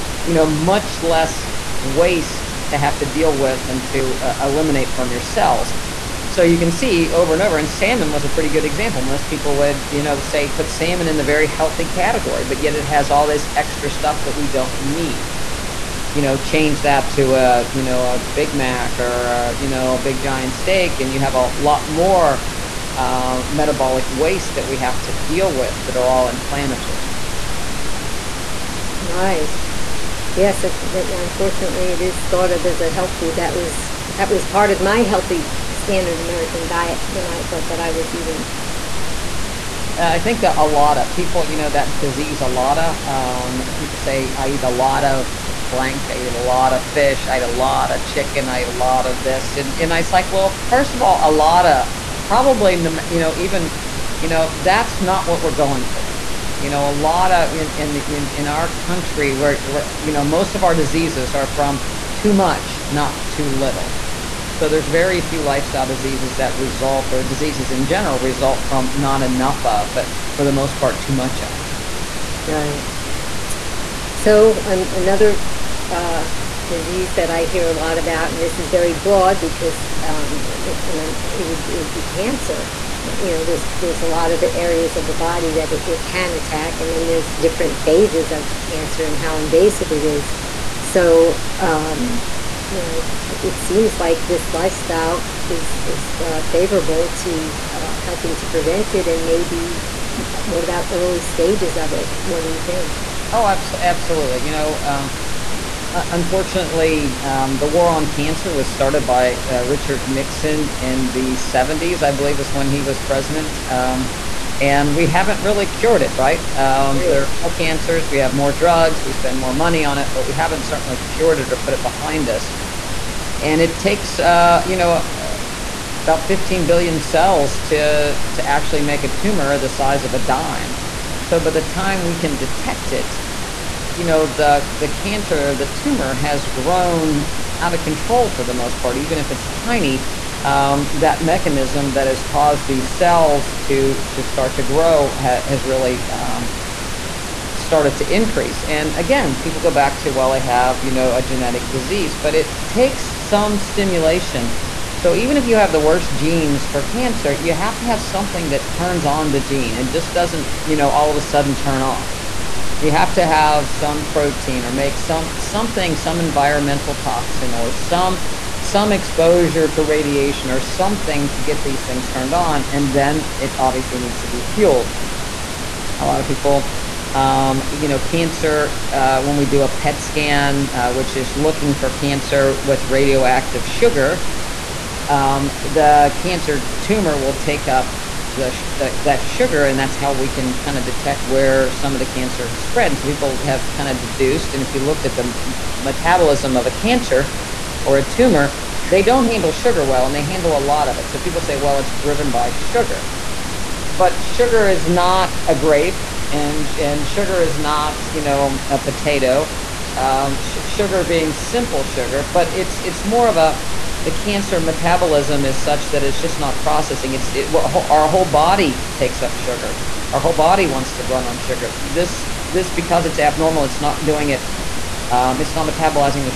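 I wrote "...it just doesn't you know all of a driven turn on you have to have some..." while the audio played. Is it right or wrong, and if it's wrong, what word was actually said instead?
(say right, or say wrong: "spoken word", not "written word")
wrong: "sudden", not "driven".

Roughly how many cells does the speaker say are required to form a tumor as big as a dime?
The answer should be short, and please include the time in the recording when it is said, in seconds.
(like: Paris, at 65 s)
15 billion, at 126 s.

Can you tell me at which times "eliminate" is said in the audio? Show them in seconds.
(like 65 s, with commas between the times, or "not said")
4 s.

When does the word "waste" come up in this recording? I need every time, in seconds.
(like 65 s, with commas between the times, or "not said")
1 s, 24 s.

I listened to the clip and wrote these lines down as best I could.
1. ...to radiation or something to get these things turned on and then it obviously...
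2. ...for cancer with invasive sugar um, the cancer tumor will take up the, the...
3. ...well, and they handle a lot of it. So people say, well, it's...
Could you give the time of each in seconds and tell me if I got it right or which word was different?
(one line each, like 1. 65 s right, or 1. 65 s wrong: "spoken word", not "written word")
1. 169 s right
2. 181 s wrong: "radioactive", not "invasive"
3. 199 s right.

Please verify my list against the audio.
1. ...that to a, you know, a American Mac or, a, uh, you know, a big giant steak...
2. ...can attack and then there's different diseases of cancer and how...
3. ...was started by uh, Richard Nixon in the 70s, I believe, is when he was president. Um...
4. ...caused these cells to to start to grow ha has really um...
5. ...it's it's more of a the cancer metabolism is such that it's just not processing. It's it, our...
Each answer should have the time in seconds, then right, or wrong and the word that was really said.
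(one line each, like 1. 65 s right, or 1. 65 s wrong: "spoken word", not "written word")
1. 16 s wrong: "Big", not "American"
2. 86 s wrong: "phases", not "diseases"
3. 108 s right
4. 142 s right
5. 212 s right.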